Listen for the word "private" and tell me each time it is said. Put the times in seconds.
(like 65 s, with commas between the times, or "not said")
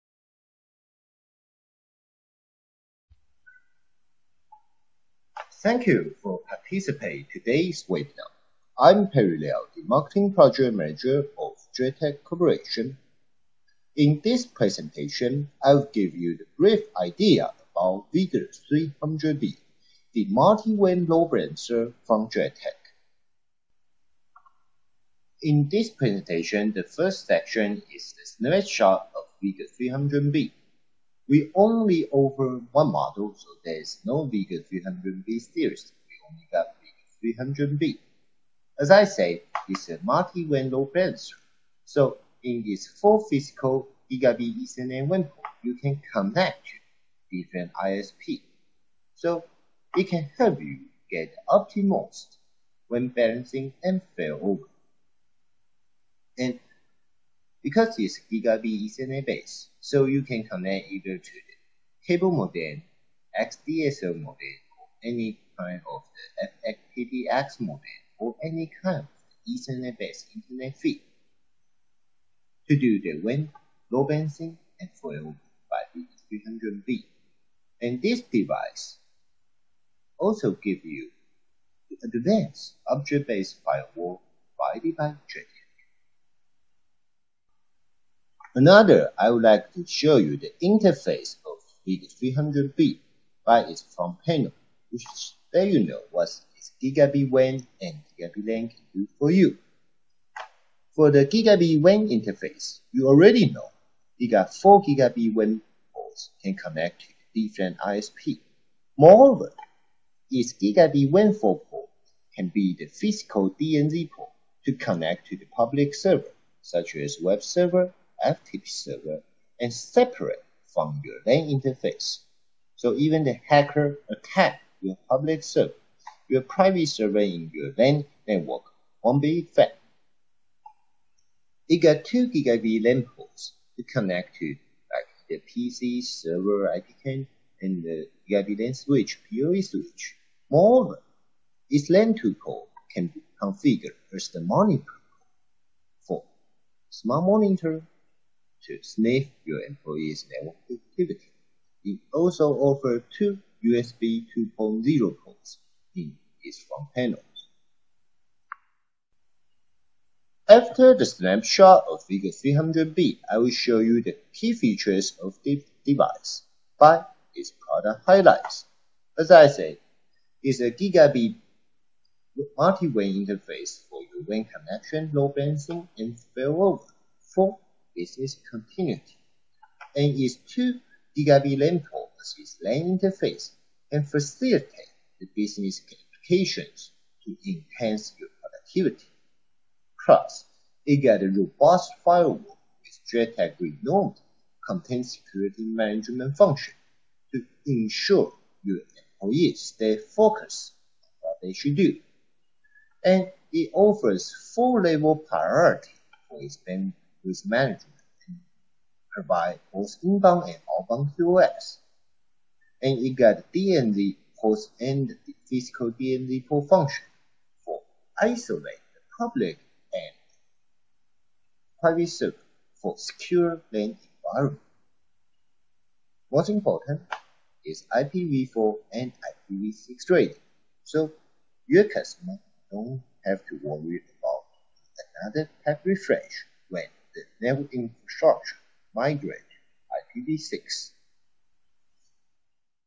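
126 s, 221 s.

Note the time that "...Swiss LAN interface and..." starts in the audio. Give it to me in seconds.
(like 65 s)
182 s.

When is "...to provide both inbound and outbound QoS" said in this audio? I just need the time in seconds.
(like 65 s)
208 s.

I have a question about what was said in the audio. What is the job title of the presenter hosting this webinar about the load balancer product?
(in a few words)
Marketing Project Manager.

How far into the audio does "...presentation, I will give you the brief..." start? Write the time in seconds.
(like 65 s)
14 s.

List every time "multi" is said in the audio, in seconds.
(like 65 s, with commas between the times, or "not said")
20 s, 40 s, 172 s.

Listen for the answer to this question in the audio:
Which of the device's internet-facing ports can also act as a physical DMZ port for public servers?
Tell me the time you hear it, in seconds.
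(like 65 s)
111 s.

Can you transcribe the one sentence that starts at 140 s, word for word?
Moreover, this LAN 2 port can be configured as the monitor for smart monitor to sniff your employees' network activity.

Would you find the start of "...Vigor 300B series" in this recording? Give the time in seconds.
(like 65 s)
34 s.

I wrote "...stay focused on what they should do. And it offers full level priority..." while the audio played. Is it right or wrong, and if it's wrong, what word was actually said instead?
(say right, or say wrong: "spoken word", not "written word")
right.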